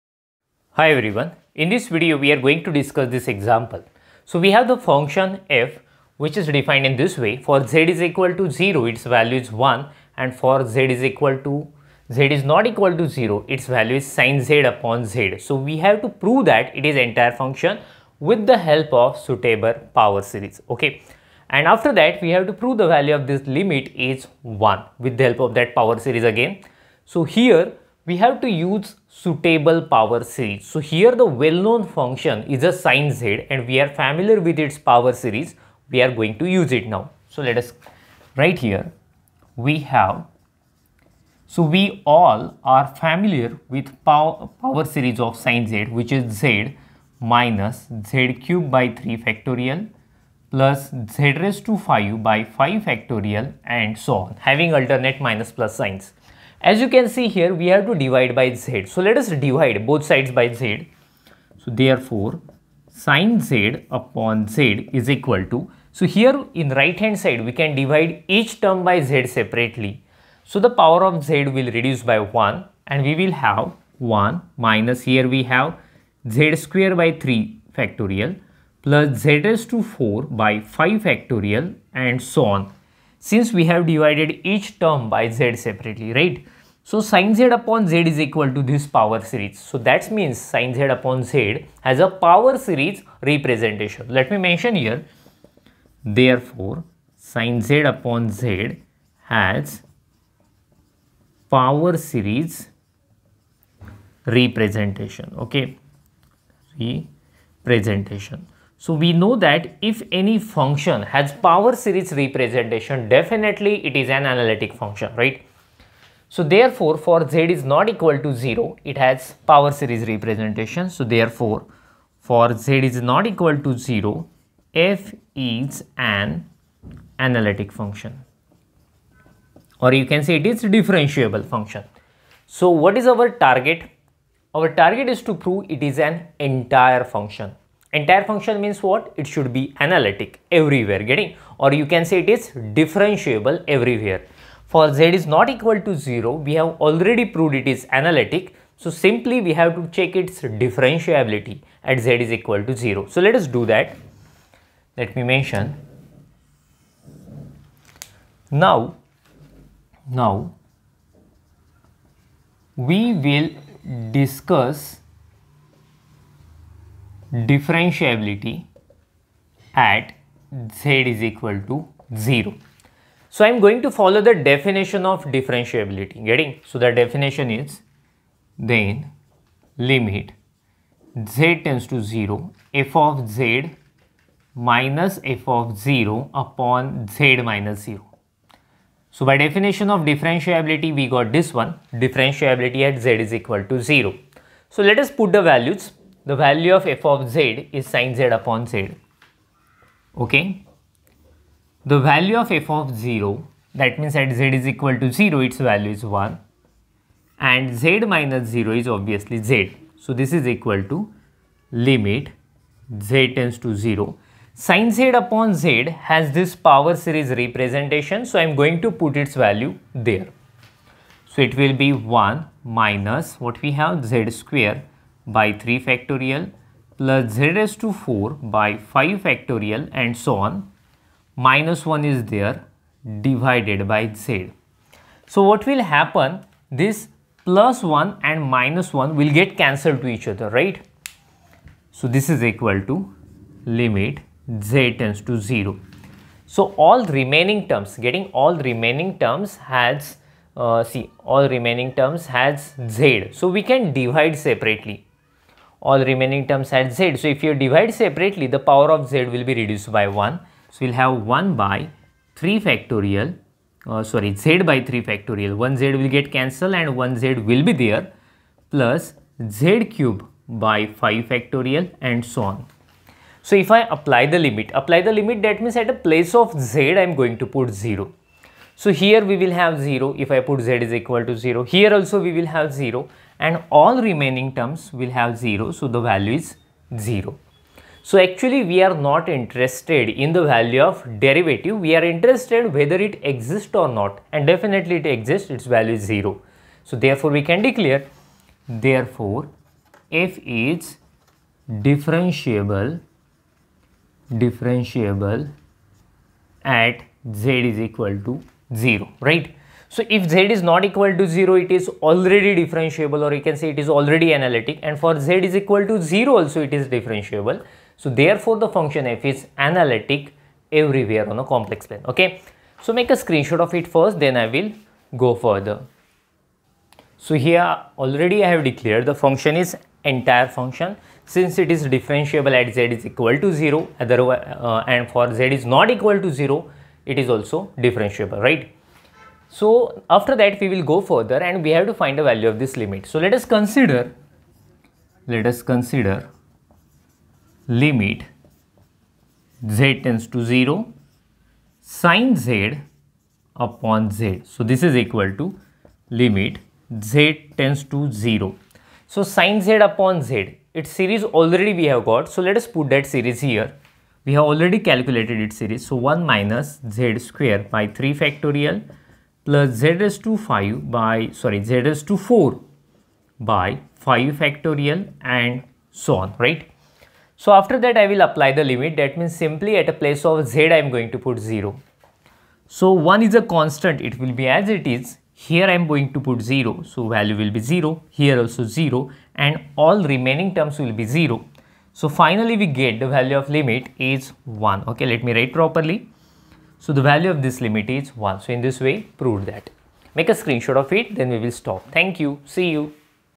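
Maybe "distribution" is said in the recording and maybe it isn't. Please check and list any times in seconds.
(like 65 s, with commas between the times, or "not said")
not said.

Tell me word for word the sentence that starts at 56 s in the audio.
As you can see here, we have to divide by z.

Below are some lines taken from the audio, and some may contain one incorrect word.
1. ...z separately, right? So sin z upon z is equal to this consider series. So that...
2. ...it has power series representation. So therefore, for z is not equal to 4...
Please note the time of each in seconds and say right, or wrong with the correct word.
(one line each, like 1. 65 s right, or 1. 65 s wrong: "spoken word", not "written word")
1. 85 s wrong: "power", not "consider"
2. 118 s wrong: "0", not "4".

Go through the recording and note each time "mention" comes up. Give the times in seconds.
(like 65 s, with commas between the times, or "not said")
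94 s, 155 s.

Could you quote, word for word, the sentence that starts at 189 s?
So by definition of differentiability, we got this one, differentiability at z is equal to 0.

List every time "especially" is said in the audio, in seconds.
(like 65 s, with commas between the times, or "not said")
not said.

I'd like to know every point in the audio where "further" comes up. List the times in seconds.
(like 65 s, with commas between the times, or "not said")
325 s, 341 s.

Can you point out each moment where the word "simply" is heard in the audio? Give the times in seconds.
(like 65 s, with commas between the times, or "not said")
148 s, 379 s.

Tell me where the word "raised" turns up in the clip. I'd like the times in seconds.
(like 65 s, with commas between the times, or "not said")
51 s, 79 s, 227 s.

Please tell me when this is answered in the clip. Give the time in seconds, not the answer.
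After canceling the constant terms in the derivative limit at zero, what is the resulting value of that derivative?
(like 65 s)
295 s.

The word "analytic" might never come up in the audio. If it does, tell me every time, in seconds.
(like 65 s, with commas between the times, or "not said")
114 s, 127 s, 139 s, 147 s, 314 s, 319 s.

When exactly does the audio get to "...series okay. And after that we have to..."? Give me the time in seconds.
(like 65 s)
20 s.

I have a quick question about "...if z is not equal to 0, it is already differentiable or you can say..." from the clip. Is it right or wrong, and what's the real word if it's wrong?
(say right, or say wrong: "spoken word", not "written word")
right.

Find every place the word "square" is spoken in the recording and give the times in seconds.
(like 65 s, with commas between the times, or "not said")
76 s, 224 s, 367 s.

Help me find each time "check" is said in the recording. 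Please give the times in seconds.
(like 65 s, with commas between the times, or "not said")
149 s.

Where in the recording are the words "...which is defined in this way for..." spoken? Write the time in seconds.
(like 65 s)
6 s.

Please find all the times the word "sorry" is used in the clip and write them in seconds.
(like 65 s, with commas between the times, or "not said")
264 s, 371 s.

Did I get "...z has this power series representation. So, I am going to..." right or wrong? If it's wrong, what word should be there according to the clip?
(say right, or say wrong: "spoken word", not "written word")
right.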